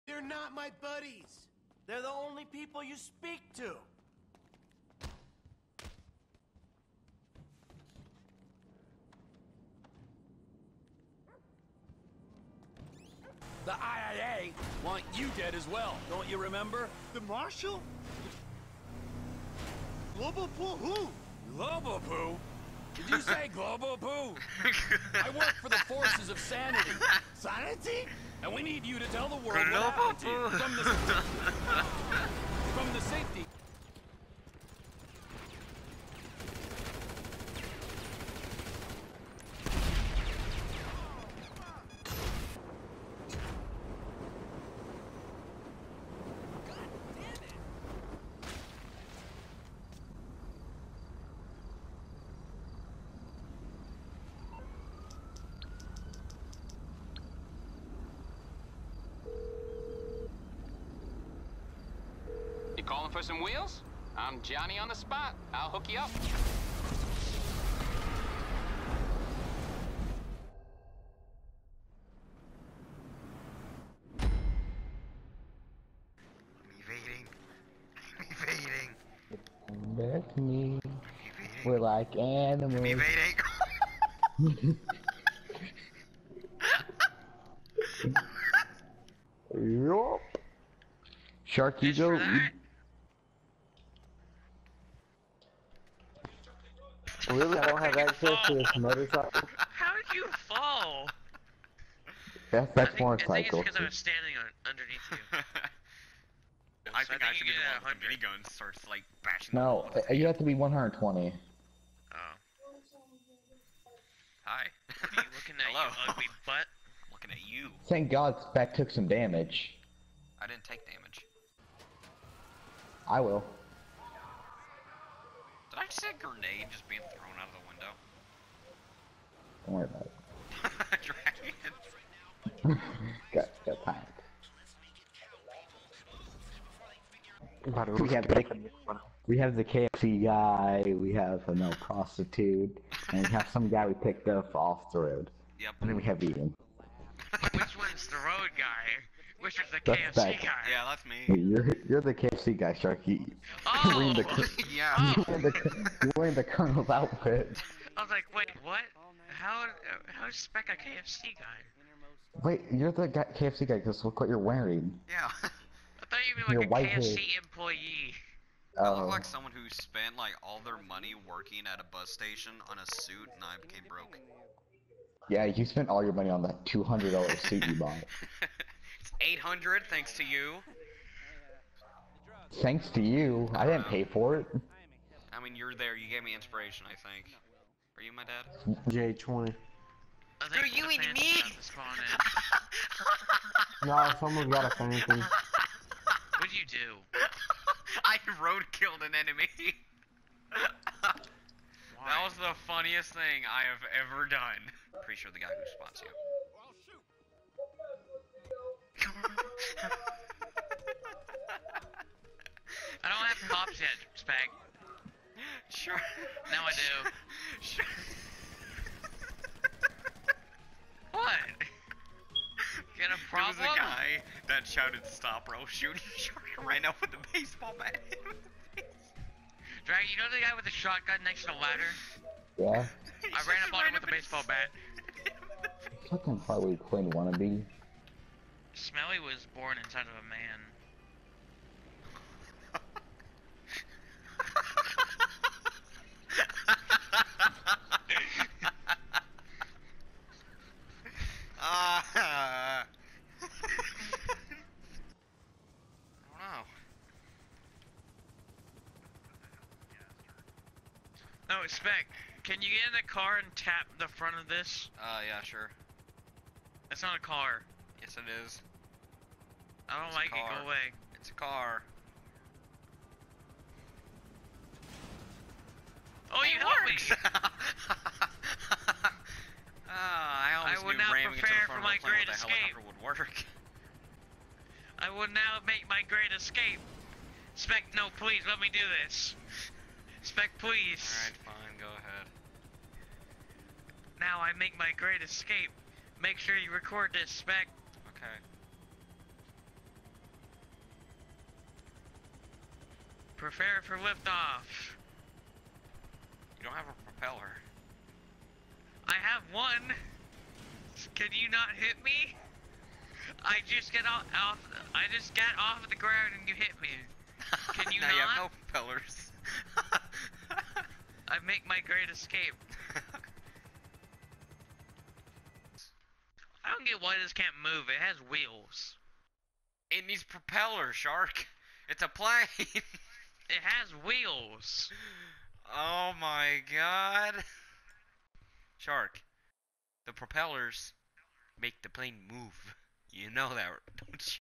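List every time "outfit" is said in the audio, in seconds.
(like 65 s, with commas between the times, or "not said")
156 s.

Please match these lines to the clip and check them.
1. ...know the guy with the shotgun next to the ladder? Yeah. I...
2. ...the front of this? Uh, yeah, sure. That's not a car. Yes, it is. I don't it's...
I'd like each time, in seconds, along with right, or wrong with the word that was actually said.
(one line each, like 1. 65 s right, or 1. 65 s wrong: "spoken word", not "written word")
1. 230 s right
2. 263 s right.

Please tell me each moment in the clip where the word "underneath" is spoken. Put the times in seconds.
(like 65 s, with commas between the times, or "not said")
104 s.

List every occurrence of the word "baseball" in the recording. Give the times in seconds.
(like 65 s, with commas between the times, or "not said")
227 s, 234 s.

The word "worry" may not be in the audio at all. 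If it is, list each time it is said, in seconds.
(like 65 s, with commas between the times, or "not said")
129 s.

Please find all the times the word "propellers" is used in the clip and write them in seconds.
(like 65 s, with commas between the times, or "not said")
307 s, 318 s, 330 s, 340 s.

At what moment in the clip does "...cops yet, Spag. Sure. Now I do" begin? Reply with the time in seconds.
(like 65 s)
213 s.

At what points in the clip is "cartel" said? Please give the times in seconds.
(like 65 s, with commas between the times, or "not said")
not said.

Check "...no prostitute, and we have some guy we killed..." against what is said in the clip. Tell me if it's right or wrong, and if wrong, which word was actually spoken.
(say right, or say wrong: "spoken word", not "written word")
wrong: "picked", not "killed".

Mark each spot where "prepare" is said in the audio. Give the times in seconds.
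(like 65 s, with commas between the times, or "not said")
281 s, 303 s.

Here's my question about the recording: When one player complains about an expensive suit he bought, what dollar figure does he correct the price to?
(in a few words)
800.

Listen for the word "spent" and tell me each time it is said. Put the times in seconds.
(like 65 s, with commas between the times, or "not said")
169 s, 175 s.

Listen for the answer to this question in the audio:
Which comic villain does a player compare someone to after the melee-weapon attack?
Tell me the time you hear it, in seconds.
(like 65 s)
236 s.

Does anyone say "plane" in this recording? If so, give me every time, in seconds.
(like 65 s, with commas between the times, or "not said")
332 s, 341 s.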